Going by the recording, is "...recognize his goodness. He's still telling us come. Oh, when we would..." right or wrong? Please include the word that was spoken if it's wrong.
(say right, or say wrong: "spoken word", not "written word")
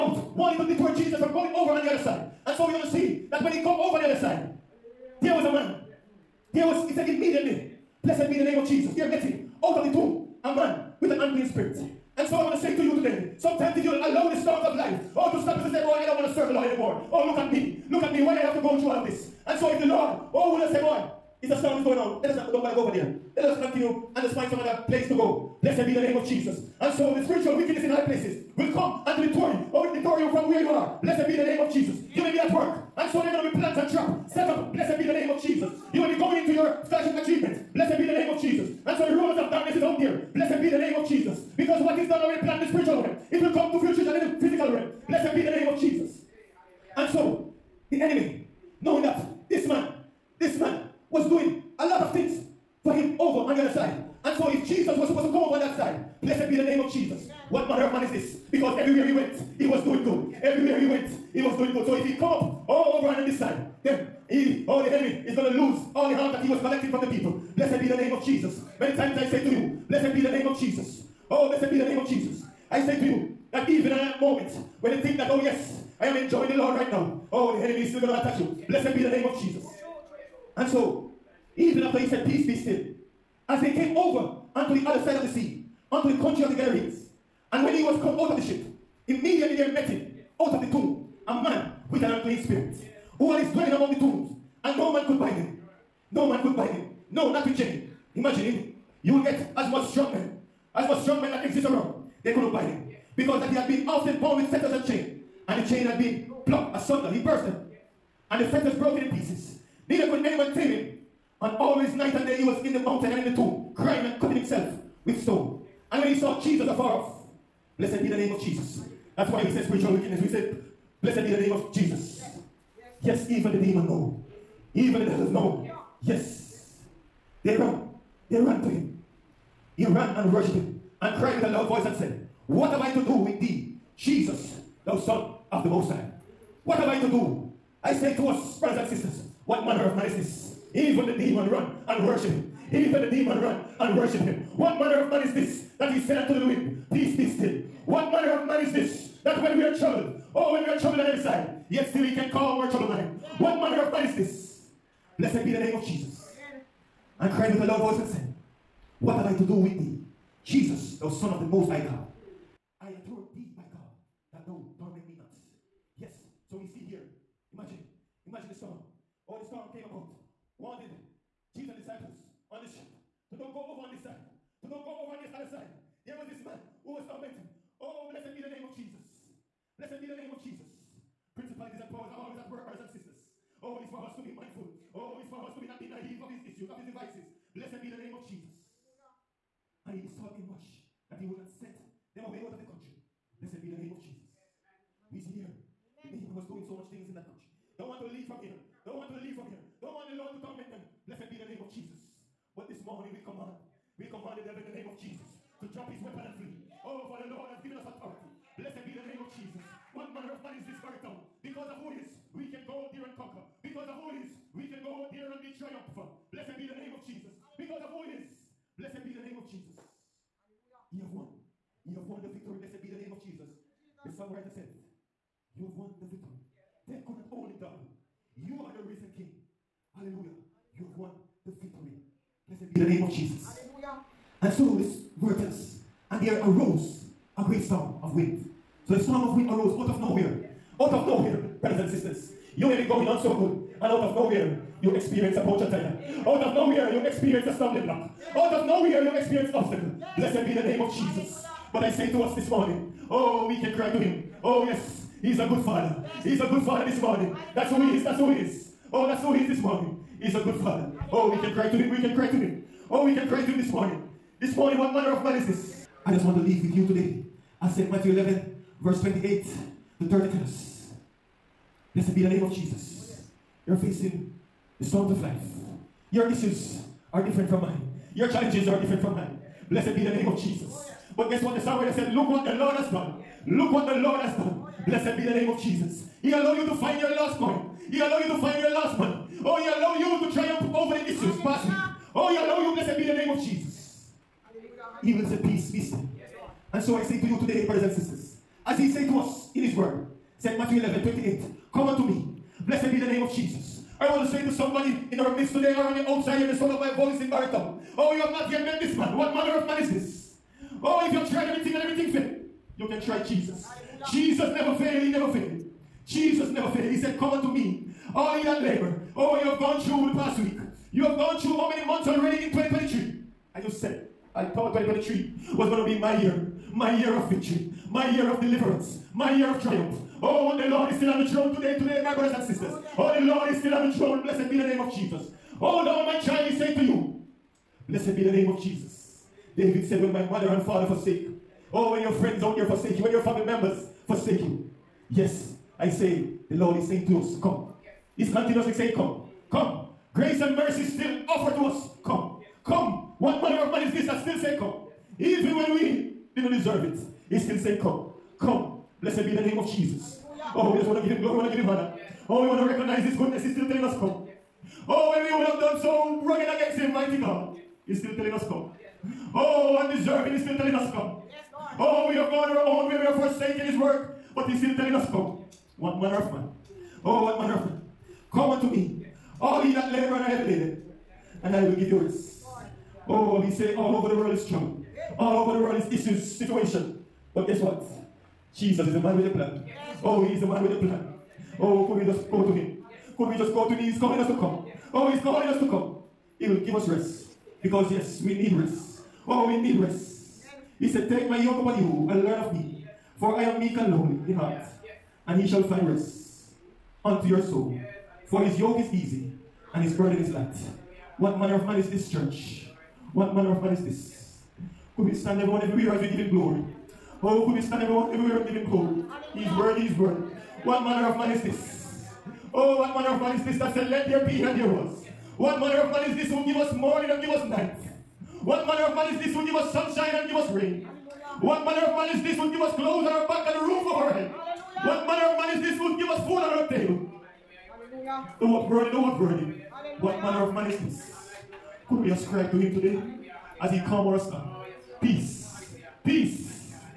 right.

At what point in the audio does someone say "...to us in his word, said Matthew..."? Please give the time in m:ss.
4:59.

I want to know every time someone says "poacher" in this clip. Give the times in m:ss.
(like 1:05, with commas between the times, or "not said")
4:05.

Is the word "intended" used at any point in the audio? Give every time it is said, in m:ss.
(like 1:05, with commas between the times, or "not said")
not said.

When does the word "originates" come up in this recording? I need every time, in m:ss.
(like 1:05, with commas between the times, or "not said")
not said.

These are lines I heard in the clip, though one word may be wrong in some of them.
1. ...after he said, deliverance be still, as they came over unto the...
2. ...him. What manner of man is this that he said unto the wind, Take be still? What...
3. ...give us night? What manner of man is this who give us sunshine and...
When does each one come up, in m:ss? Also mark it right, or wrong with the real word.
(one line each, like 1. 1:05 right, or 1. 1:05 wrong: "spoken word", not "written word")
1. 1:21 wrong: "peace", not "deliverance"
2. 2:24 wrong: "Peace", not "Take"
3. 7:07 right.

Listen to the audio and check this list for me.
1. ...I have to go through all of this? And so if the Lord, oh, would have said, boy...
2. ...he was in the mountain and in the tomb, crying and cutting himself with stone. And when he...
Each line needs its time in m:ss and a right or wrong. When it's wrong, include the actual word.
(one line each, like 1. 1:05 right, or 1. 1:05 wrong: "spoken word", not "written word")
1. 0:18 right
2. 1:52 right.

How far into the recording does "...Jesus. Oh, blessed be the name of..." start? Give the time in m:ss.
1:10.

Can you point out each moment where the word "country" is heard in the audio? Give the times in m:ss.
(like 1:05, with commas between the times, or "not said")
1:26, 3:12, 3:17.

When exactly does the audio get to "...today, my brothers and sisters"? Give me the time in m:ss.
5:31.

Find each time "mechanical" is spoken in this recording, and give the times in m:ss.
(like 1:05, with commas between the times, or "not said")
not said.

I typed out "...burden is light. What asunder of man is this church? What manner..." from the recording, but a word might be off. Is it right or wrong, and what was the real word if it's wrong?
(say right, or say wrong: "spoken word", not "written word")
wrong: "manner", not "asunder".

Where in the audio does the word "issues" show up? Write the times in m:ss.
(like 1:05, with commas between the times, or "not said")
3:06, 4:36, 4:51, 6:25.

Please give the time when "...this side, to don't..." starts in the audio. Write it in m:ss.
2:53.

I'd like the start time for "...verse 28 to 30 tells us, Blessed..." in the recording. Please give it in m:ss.
4:28.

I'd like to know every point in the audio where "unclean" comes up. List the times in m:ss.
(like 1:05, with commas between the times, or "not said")
0:11, 1:32.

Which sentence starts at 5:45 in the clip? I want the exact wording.
Yes, I say the Lord is saying to us, come.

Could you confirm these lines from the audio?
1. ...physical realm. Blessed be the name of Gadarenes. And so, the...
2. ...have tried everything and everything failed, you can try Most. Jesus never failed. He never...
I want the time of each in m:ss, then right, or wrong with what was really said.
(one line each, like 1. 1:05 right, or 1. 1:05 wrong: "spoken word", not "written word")
1. 0:44 wrong: "Jesus", not "Gadarenes"
2. 5:11 wrong: "Jesus", not "Most".